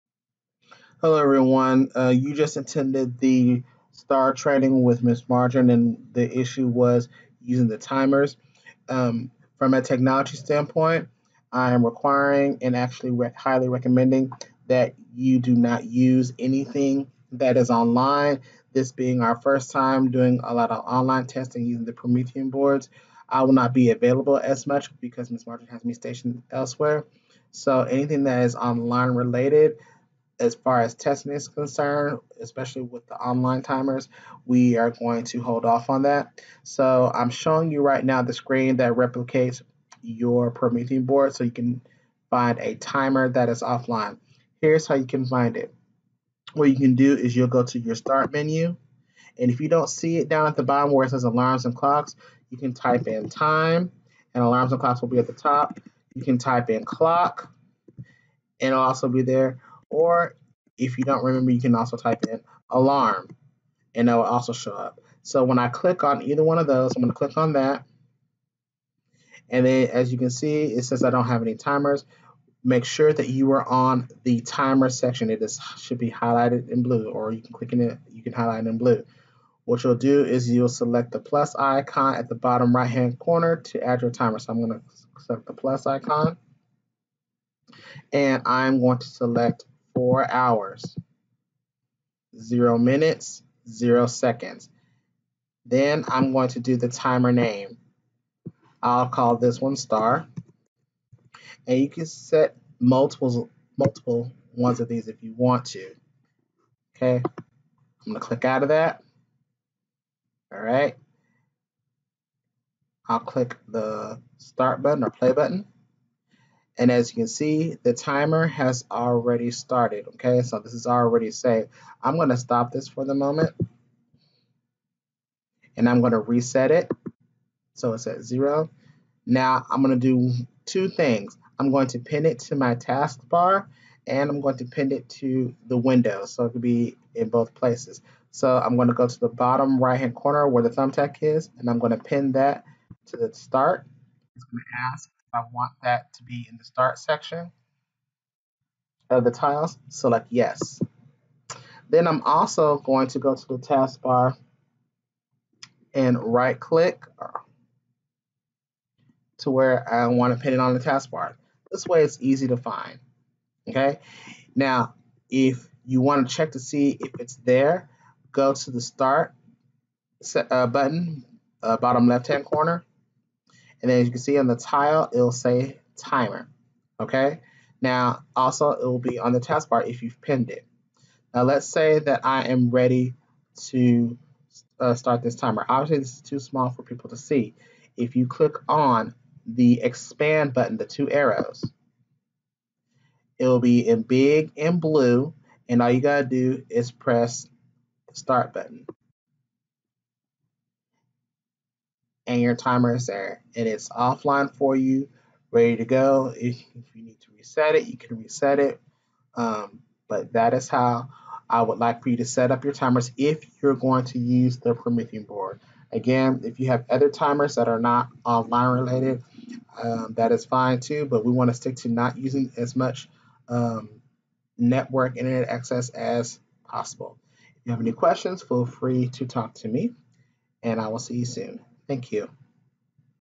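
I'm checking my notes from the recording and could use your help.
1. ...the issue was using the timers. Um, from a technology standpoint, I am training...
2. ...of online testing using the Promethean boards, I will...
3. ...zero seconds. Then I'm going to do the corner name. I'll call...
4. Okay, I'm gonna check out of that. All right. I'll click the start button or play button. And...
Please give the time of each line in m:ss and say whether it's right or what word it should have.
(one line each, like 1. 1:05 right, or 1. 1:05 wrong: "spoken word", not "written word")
1. 0:06 wrong: "requiring", not "training"
2. 0:20 right
3. 1:33 wrong: "timer", not "corner"
4. 1:46 wrong: "click", not "check".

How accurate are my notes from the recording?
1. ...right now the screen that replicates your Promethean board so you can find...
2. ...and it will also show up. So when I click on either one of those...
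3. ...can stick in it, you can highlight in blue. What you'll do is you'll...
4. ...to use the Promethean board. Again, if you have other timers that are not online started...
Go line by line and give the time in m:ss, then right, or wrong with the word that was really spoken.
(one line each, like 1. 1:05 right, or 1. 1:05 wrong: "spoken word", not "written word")
1. 0:37 right
2. 1:03 right
3. 1:17 wrong: "click", not "stick"
4. 3:34 wrong: "related", not "started".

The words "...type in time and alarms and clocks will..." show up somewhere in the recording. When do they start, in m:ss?
0:52.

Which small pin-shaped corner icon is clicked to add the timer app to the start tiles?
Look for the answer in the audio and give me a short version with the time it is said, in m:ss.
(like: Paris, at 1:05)
thumbtack, at 2:20.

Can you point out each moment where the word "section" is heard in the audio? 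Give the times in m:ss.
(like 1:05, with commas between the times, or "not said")
1:14, 2:26.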